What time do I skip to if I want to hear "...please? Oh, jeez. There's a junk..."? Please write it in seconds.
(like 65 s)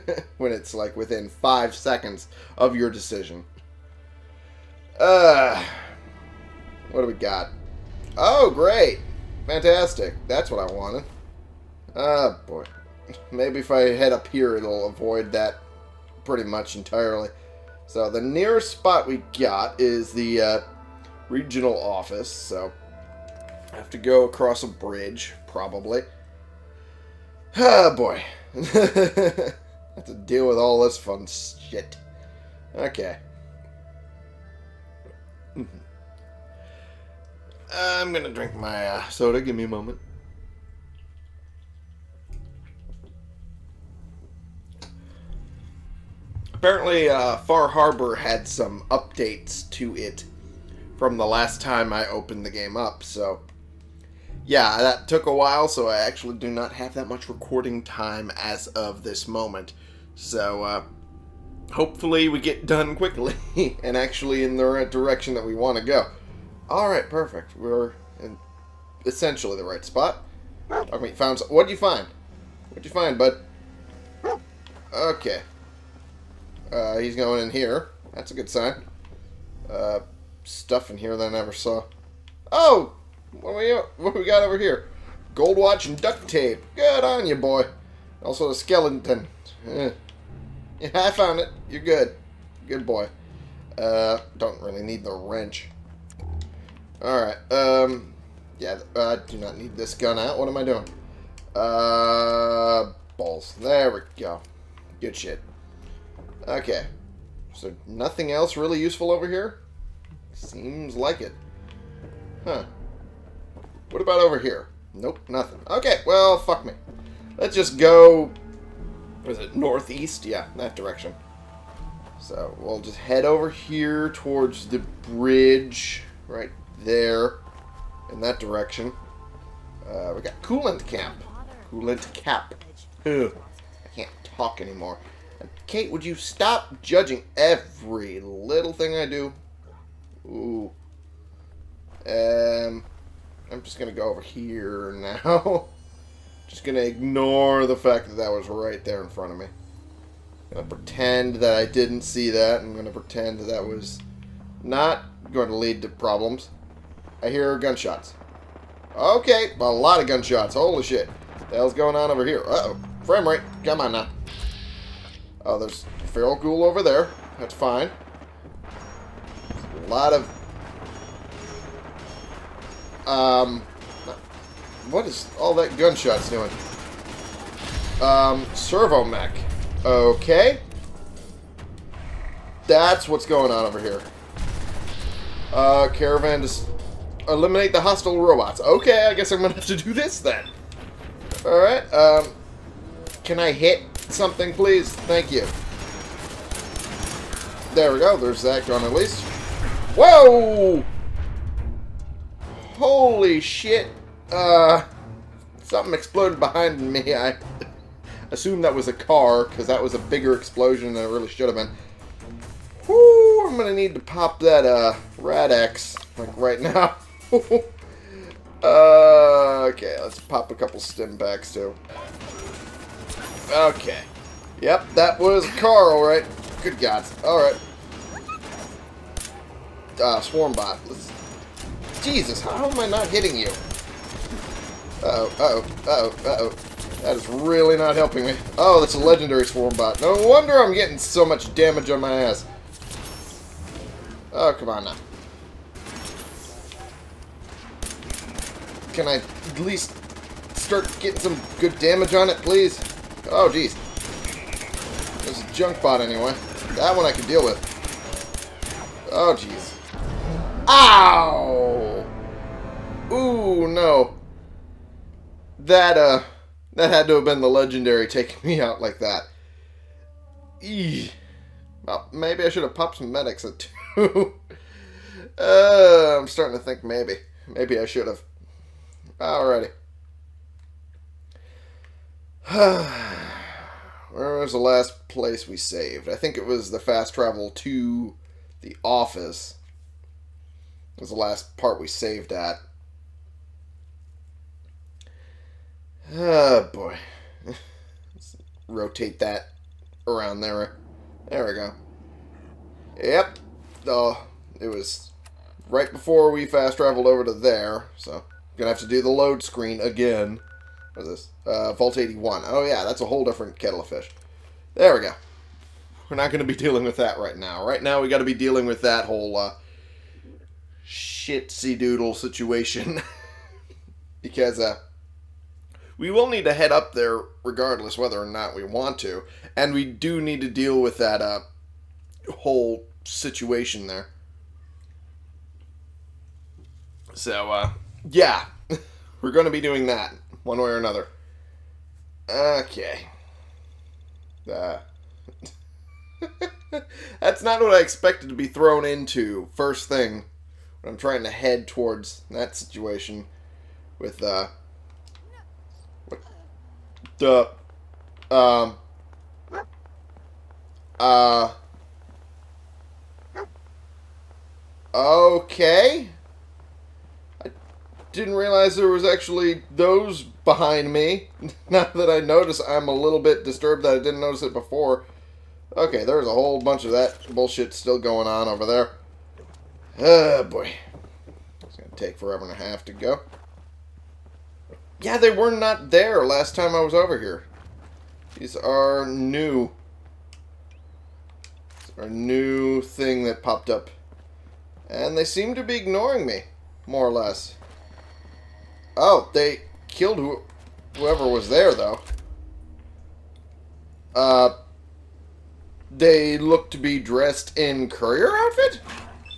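252 s.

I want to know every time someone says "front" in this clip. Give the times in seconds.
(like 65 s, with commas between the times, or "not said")
149 s.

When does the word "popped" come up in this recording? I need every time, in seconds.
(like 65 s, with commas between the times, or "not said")
272 s, 393 s.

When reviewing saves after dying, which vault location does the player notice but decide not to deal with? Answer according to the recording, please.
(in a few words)
Vault 81.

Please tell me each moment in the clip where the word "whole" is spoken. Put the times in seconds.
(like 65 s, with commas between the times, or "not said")
313 s, 319 s, 332 s, 376 s.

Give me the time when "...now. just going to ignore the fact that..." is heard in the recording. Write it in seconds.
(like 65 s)
145 s.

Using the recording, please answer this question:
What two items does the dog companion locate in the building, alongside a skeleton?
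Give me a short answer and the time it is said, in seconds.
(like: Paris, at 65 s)
Gold watch and duct tape, at 85 s.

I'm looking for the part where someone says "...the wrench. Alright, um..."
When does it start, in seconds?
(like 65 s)
95 s.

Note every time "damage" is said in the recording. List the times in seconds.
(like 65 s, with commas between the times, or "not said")
241 s, 251 s.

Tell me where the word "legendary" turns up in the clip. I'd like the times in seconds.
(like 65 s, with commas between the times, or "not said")
238 s, 267 s.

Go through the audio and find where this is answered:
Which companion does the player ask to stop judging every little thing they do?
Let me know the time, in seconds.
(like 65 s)
135 s.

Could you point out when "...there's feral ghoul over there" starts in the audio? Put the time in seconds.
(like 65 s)
165 s.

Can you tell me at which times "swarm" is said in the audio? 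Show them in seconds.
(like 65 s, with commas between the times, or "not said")
230 s, 239 s.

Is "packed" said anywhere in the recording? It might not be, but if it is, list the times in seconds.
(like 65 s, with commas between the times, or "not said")
not said.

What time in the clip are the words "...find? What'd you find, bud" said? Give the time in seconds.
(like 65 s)
71 s.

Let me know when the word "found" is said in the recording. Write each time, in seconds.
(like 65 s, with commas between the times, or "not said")
71 s, 91 s.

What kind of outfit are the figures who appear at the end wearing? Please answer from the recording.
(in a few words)
Courier outfit.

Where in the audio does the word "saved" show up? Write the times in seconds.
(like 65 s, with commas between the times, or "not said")
285 s, 291 s.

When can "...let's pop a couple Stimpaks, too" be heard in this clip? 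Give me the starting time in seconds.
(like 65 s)
220 s.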